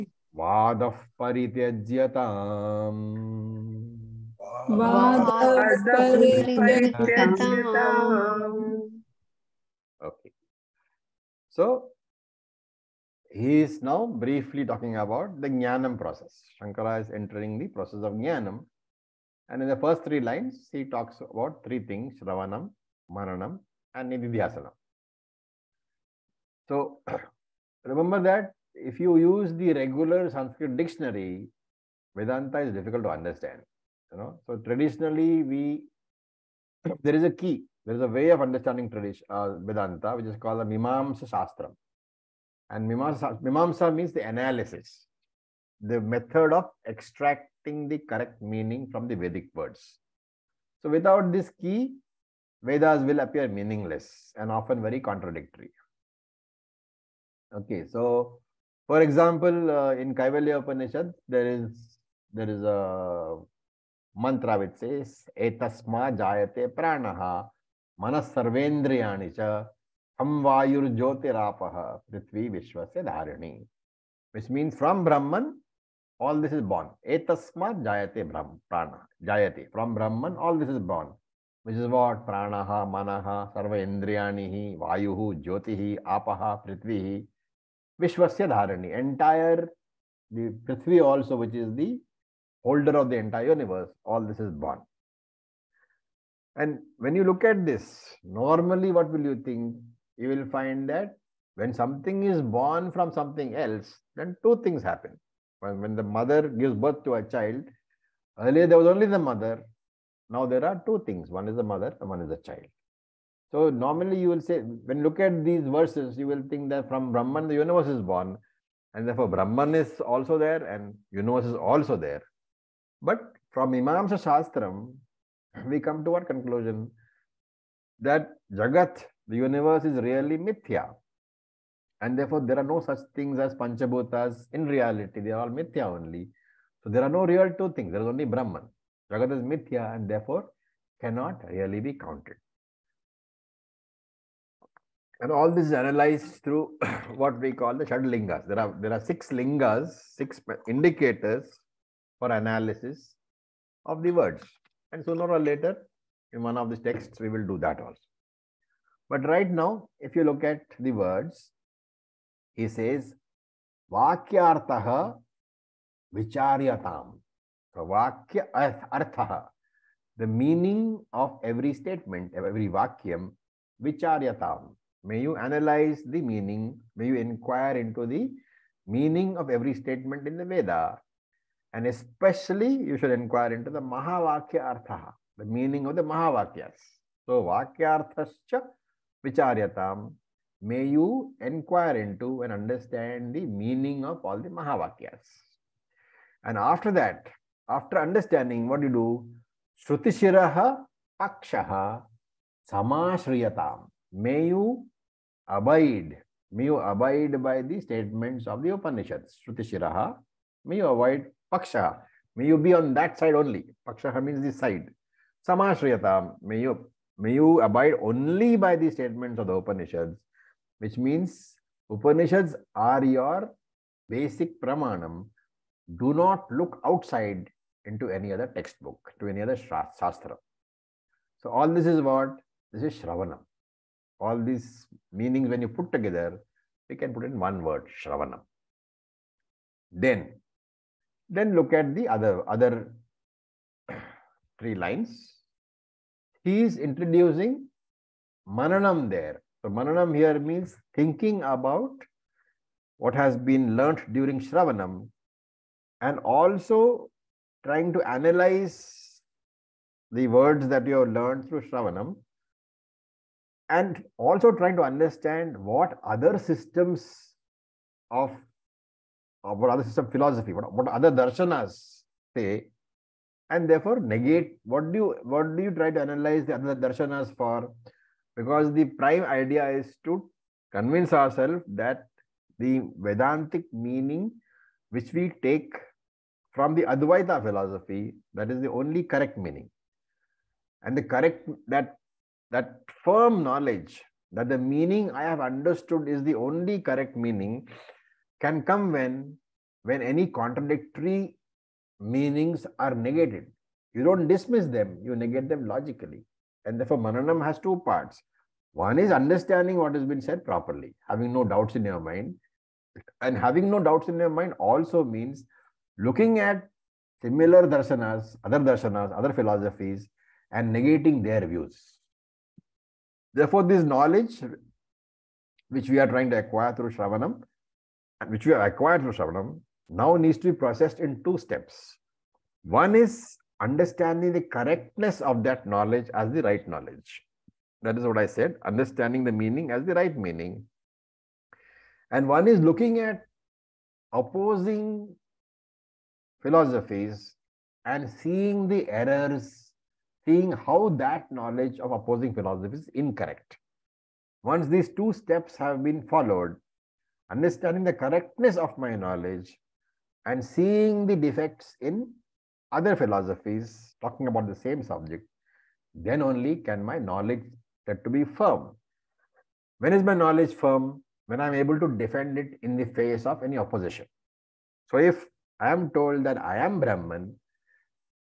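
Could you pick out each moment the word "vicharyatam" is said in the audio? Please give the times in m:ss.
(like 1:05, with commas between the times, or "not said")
2:46, 2:53, 3:09.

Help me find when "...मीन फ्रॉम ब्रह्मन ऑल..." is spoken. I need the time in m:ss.
1:14.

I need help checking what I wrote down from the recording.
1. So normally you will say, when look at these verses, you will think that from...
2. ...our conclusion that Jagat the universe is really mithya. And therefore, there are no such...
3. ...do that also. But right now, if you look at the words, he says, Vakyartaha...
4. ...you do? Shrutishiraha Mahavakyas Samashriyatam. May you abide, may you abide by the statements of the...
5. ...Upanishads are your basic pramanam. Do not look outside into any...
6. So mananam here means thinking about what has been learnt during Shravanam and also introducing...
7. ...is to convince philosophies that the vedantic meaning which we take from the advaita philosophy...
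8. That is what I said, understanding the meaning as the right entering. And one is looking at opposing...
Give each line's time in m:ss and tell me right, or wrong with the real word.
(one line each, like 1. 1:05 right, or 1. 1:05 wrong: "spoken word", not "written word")
1. 1:53 right
2. 2:06 right
3. 2:37 right
4. 3:18 wrong: "Pakshaha", not "Mahavakyas"
5. 3:41 right
6. 4:09 wrong: "trying", not "introducing"
7. 4:39 wrong: "ourselves", not "philosophies"
8. 5:37 wrong: "meaning", not "entering".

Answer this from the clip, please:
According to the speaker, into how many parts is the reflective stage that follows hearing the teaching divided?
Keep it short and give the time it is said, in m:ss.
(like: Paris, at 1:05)
2, at 5:07.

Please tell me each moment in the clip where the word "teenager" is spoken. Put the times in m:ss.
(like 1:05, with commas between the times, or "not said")
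not said.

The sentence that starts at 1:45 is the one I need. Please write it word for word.
When, when the mother gives birth to a child, earlier there was only the mother.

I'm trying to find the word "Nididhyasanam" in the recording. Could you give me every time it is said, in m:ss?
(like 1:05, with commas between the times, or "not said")
0:24.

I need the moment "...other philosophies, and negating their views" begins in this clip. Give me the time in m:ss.
5:19.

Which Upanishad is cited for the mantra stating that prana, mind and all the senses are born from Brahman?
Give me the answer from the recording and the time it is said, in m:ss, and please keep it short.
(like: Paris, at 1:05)
Kaivalya Upanishad, at 1:00.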